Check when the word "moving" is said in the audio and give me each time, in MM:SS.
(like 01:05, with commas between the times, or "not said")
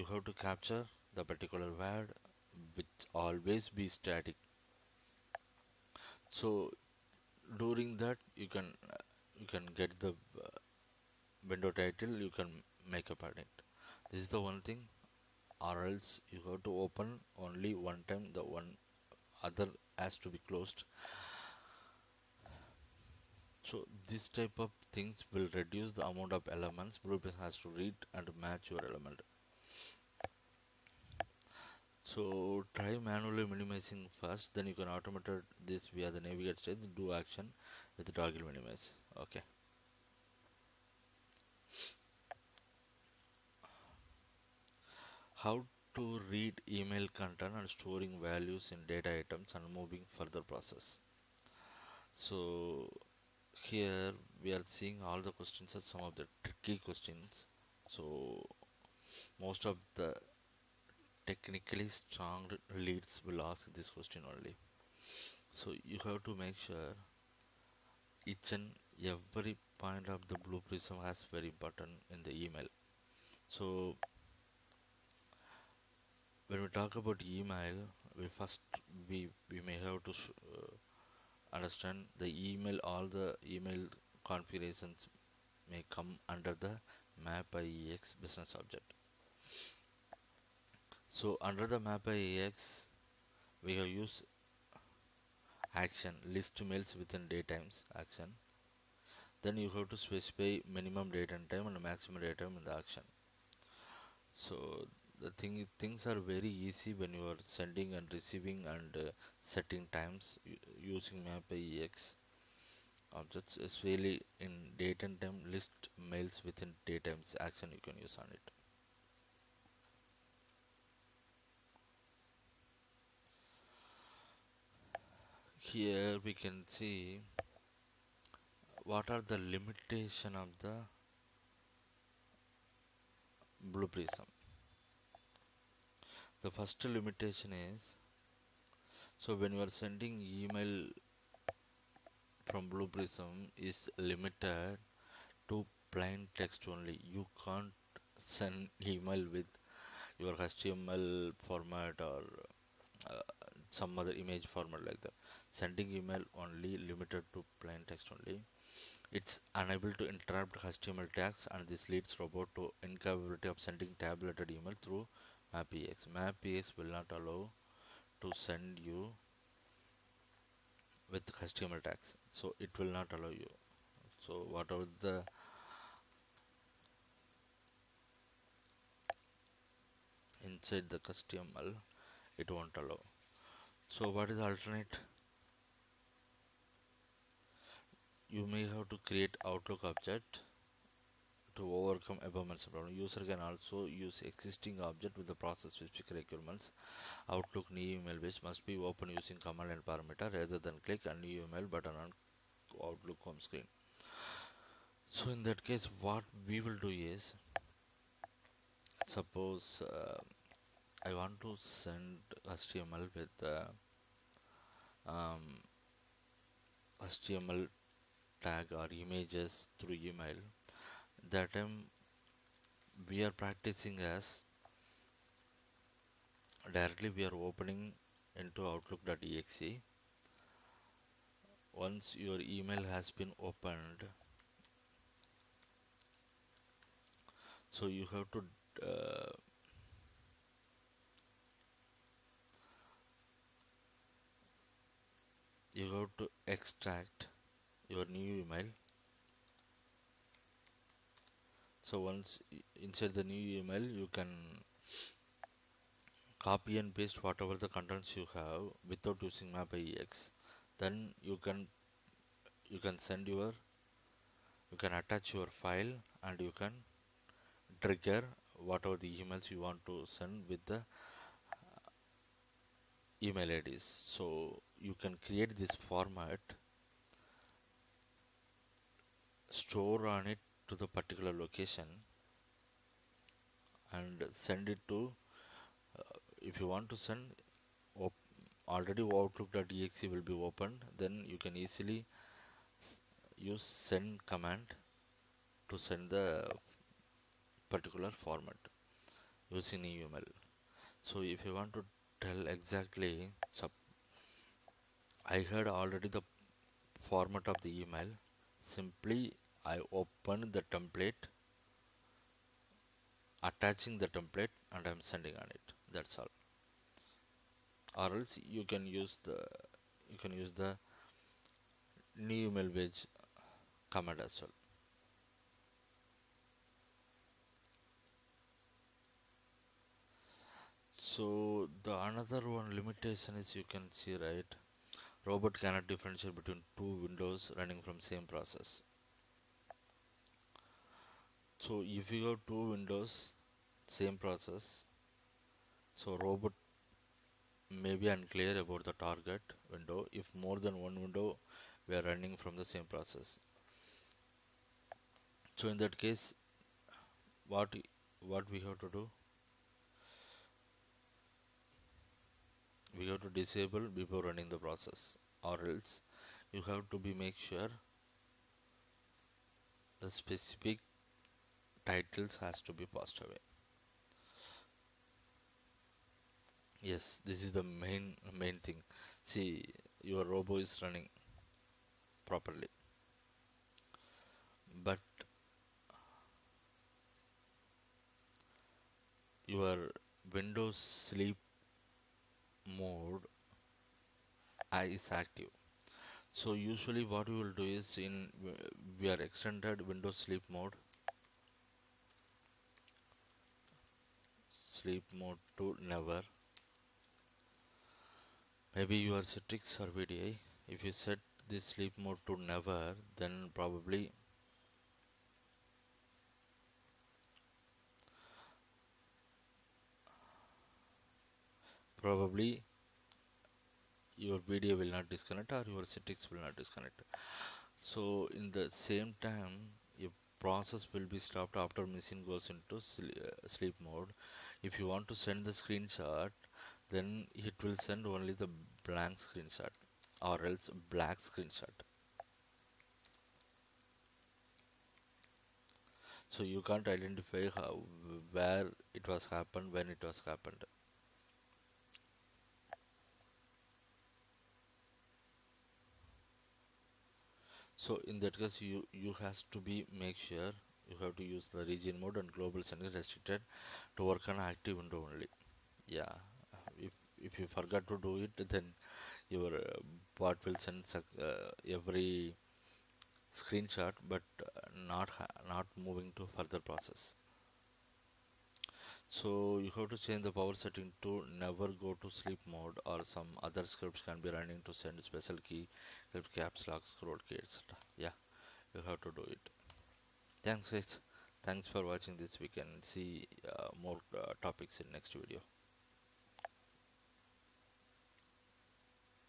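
00:49, 07:55.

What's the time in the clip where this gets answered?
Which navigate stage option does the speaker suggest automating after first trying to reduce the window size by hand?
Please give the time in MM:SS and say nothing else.
00:38.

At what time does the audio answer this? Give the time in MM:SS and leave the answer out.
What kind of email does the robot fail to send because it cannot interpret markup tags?
02:43.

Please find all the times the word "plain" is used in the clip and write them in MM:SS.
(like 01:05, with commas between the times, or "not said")
02:25, 02:37.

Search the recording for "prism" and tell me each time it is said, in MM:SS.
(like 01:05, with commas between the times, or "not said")
00:27, 01:10, 02:13, 02:22.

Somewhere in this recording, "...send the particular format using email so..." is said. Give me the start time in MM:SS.
04:55.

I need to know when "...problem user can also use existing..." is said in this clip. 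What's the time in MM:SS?
03:12.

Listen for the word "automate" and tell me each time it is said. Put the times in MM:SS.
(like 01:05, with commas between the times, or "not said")
00:34.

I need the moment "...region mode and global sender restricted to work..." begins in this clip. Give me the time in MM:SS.
07:41.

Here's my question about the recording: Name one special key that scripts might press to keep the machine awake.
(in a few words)
caps lock.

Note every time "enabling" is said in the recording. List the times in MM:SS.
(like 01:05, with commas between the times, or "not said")
not said.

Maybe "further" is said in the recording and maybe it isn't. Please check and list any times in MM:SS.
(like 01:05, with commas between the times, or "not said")
00:50, 07:56.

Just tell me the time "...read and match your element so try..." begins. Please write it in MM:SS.
00:27.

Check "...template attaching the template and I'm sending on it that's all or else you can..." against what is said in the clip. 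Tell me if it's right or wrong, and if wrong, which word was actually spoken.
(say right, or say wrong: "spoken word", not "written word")
right.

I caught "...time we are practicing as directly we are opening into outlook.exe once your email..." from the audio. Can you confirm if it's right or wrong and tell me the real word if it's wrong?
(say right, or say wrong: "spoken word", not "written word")
right.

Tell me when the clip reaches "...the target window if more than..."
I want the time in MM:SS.
05:48.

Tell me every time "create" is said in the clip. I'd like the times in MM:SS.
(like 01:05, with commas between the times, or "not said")
03:09, 04:35.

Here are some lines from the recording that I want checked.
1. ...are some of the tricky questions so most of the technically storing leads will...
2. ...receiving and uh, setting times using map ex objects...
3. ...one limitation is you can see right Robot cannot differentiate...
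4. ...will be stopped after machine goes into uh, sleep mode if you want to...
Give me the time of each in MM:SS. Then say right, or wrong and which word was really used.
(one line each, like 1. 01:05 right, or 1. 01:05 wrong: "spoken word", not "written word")
1. 00:55 wrong: "strong", not "storing"
2. 01:48 right
3. 05:32 right
4. 07:10 right.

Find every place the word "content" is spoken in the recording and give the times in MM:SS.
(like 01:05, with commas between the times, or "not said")
00:47, 04:17.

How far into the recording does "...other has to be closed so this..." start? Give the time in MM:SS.
00:19.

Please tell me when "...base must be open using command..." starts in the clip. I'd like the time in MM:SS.
03:18.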